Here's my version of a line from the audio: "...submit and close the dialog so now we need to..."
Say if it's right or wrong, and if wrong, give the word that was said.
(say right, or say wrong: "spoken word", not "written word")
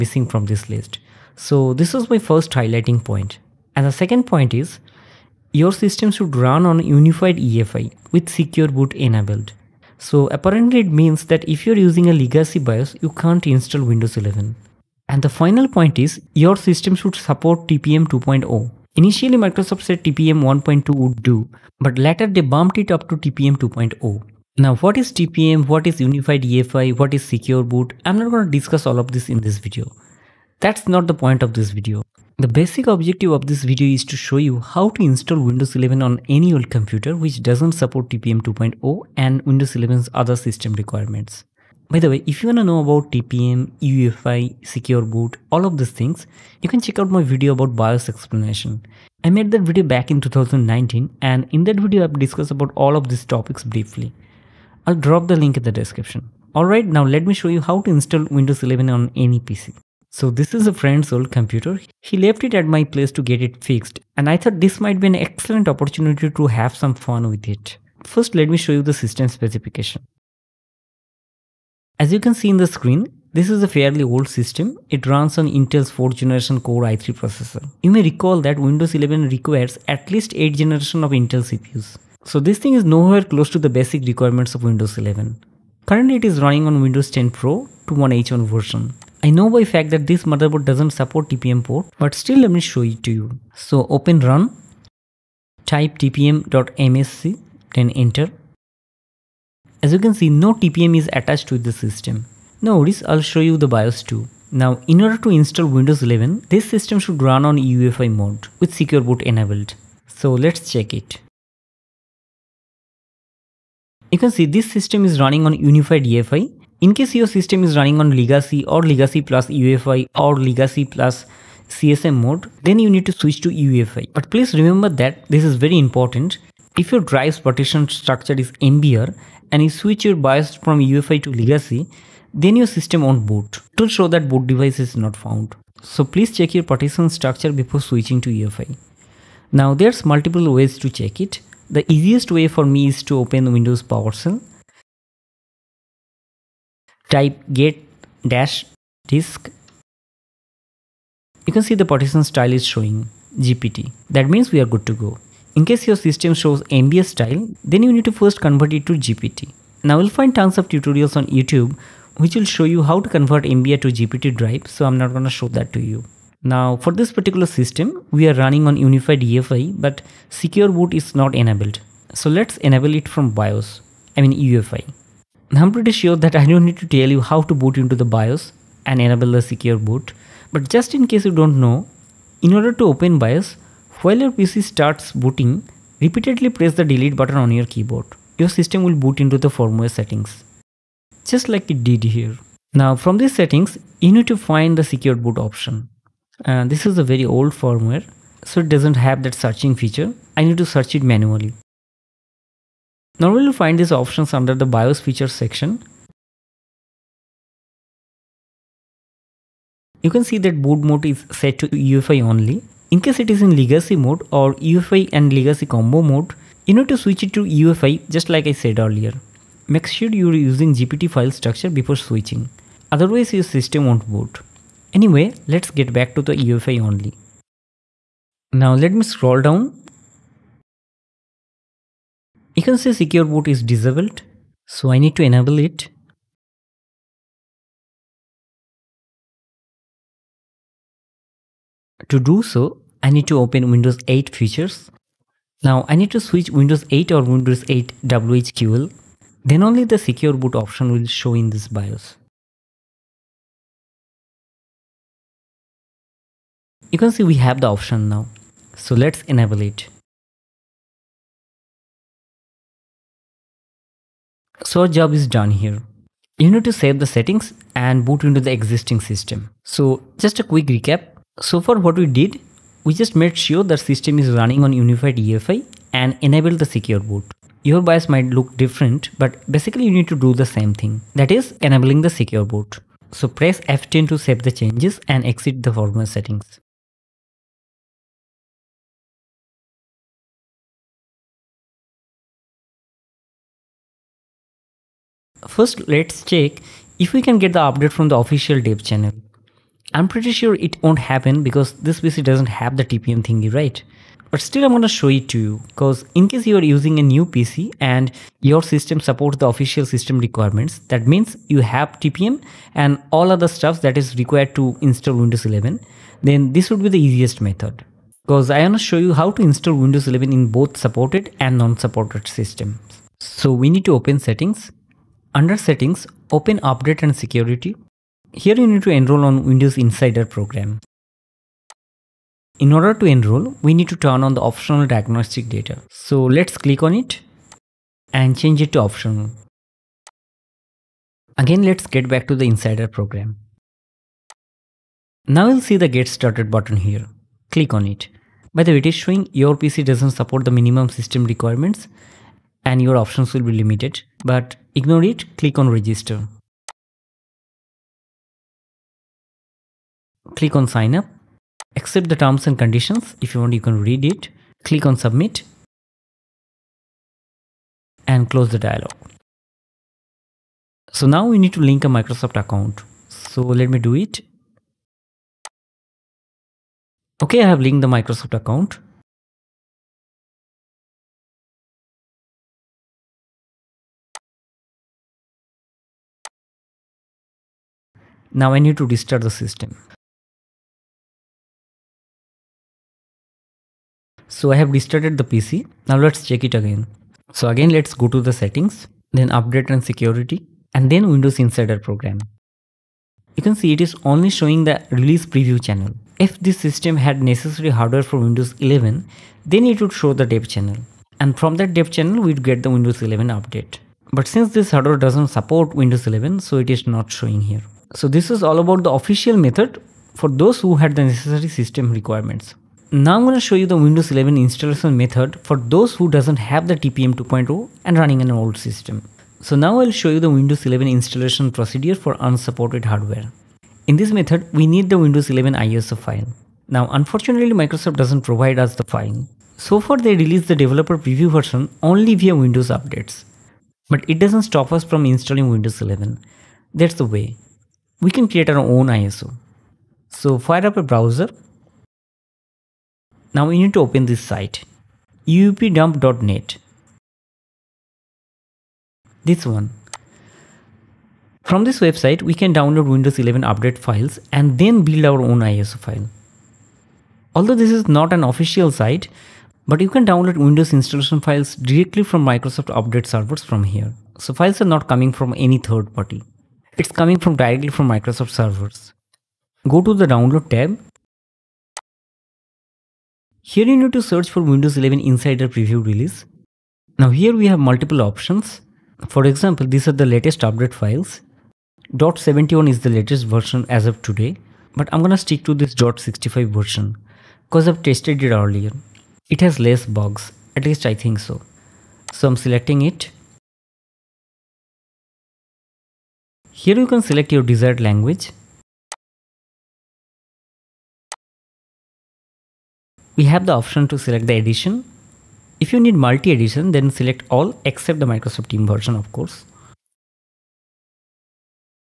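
right.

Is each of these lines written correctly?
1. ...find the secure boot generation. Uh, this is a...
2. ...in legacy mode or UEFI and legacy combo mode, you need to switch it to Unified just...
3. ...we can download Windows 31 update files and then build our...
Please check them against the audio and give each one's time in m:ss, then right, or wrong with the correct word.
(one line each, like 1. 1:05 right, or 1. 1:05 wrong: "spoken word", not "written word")
1. 3:14 wrong: "option", not "generation"
2. 3:33 wrong: "UEFI", not "Unified"
3. 7:42 wrong: "11", not "31".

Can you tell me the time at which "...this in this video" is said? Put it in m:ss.
0:29.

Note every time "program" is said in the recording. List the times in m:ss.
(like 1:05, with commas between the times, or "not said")
5:30, 5:42, 6:41.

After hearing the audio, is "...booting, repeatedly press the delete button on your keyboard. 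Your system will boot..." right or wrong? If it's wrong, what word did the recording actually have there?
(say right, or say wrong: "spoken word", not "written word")
right.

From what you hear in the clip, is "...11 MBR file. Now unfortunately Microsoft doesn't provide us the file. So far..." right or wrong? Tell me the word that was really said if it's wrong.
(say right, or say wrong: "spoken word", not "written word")
wrong: "ISO", not "MBR".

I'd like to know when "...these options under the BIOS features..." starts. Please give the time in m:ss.
3:23.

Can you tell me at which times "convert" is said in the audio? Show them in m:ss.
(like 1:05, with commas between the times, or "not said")
2:38, 2:43.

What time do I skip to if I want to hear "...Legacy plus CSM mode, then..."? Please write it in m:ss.
2:00.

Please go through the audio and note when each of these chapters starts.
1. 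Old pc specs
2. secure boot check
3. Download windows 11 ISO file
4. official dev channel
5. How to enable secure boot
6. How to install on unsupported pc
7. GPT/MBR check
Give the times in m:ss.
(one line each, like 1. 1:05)
1. 0:59
2. 1:50
3. 7:14
4. 4:52
5. 3:00
6. 6:58
7. 2:06.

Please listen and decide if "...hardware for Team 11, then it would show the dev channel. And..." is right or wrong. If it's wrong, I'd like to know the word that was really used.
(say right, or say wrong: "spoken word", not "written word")
wrong: "Windows", not "Team".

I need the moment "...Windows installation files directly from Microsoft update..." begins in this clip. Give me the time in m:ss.
7:50.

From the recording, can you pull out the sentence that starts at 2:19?
Now there's multiple ways to check it.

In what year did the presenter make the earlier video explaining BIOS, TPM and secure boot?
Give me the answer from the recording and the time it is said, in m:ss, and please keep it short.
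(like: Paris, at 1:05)
2019, at 0:50.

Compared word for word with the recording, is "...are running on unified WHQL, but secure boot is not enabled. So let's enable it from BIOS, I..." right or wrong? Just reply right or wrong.
wrong.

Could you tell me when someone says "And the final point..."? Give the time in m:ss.
0:15.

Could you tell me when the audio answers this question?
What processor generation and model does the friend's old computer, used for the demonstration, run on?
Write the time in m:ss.
1:15.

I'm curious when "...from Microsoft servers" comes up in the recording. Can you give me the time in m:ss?
7:57.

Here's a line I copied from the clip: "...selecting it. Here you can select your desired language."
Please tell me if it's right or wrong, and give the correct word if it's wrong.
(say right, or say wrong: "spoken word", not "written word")
right.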